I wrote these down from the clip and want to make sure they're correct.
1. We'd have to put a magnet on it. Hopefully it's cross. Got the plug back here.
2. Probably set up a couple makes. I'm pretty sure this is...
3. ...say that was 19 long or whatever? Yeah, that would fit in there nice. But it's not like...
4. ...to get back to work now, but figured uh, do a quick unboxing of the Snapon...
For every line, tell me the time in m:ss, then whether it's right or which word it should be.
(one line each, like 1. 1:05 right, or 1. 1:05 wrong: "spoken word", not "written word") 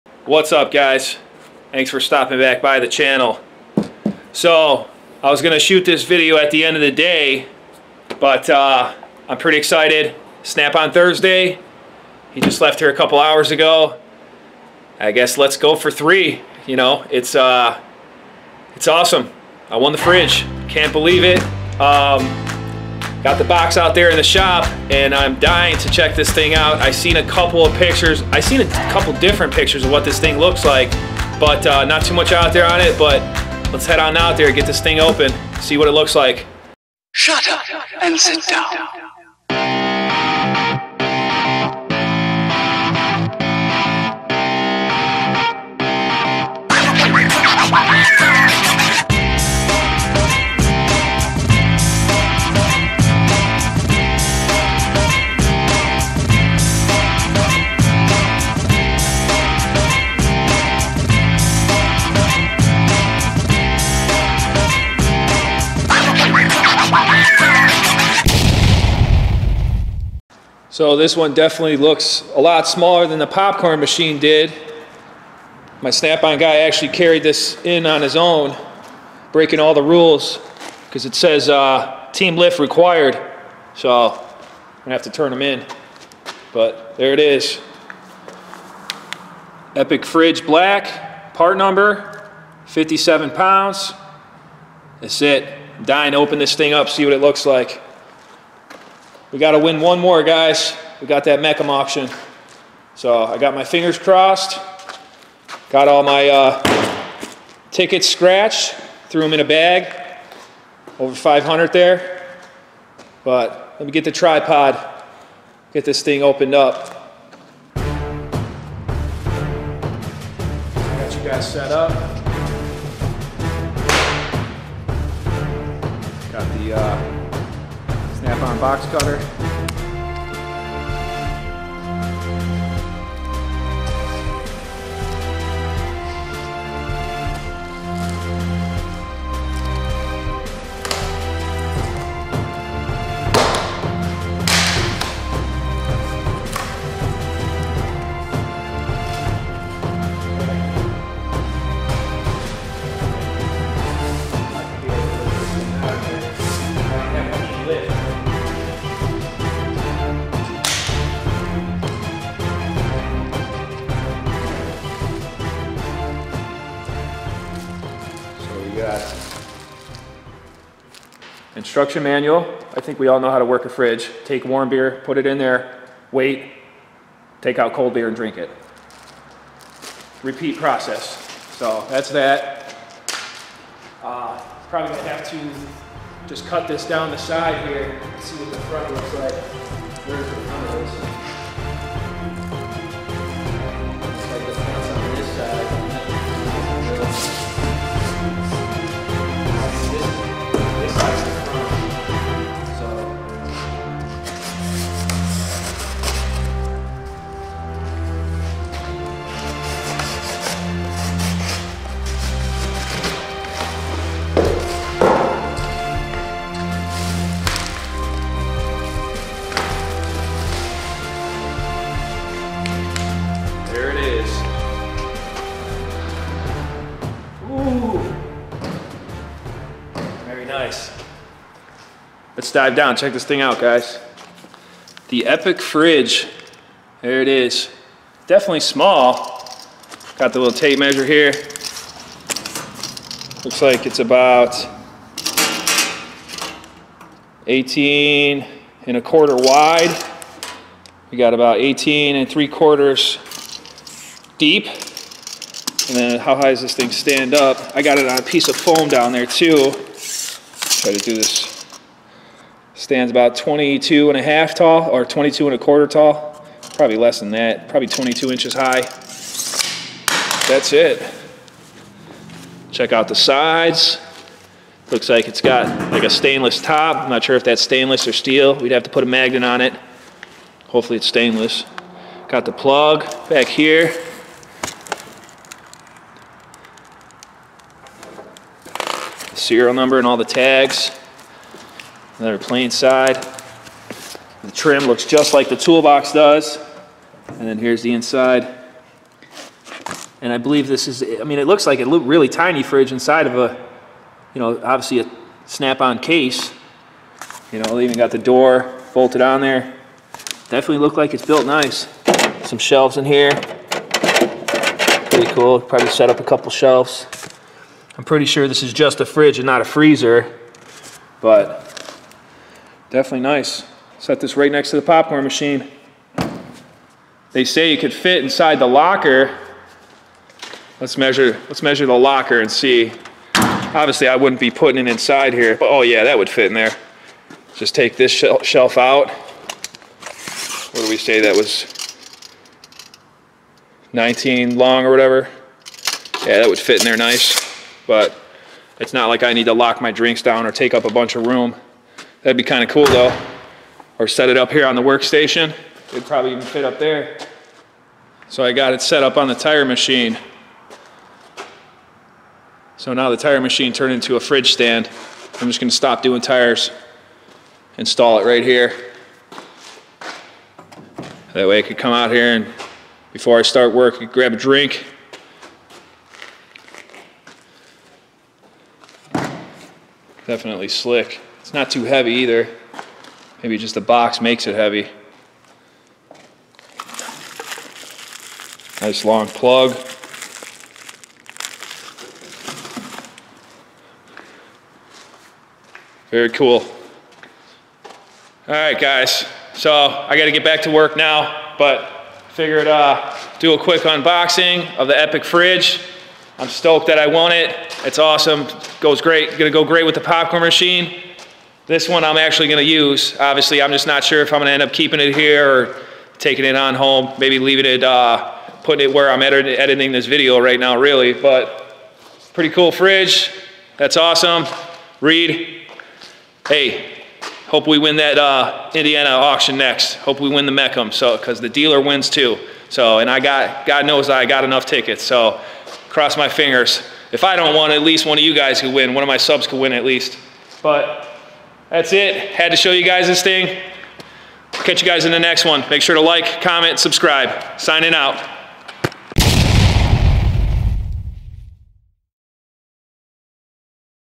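1. 4:38 wrong: "stainless", not "cross"
2. 5:15 wrong: "shelves", not "makes"
3. 5:40 right
4. 6:40 wrong: "Epiq", not "Snapon".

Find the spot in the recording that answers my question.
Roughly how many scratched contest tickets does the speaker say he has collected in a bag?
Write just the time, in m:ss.
1:50.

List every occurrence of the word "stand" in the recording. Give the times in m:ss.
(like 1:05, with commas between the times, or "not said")
4:16, 4:22, 6:04.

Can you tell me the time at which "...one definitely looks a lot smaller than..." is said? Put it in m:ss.
1:11.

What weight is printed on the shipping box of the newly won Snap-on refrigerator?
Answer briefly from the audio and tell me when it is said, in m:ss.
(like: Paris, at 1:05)
57 pounds, at 1:32.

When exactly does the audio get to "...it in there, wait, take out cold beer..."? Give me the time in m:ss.
2:55.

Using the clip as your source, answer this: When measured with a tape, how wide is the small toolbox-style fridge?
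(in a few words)
18 and a quarter inches.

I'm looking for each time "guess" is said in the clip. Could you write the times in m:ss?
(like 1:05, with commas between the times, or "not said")
0:15.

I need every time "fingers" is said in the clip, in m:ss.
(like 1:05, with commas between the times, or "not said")
1:43, 7:16.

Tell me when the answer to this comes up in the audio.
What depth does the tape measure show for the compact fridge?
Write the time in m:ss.
4:11.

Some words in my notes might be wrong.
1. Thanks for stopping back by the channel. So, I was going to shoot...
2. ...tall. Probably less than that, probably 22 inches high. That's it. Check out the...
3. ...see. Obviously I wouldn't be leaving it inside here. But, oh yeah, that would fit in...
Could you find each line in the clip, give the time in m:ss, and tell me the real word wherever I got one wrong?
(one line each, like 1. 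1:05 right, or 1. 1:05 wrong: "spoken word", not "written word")
1. 0:01 right
2. 4:25 right
3. 5:32 wrong: "putting", not "leaving".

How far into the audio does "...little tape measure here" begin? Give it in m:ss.
4:00.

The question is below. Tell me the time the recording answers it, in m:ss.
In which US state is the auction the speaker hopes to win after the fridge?
7:08.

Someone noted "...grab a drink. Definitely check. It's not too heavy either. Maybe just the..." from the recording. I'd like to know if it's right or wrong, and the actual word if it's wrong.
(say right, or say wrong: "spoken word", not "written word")
wrong: "slick", not "check".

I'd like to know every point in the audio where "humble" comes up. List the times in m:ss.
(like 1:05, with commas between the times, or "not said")
not said.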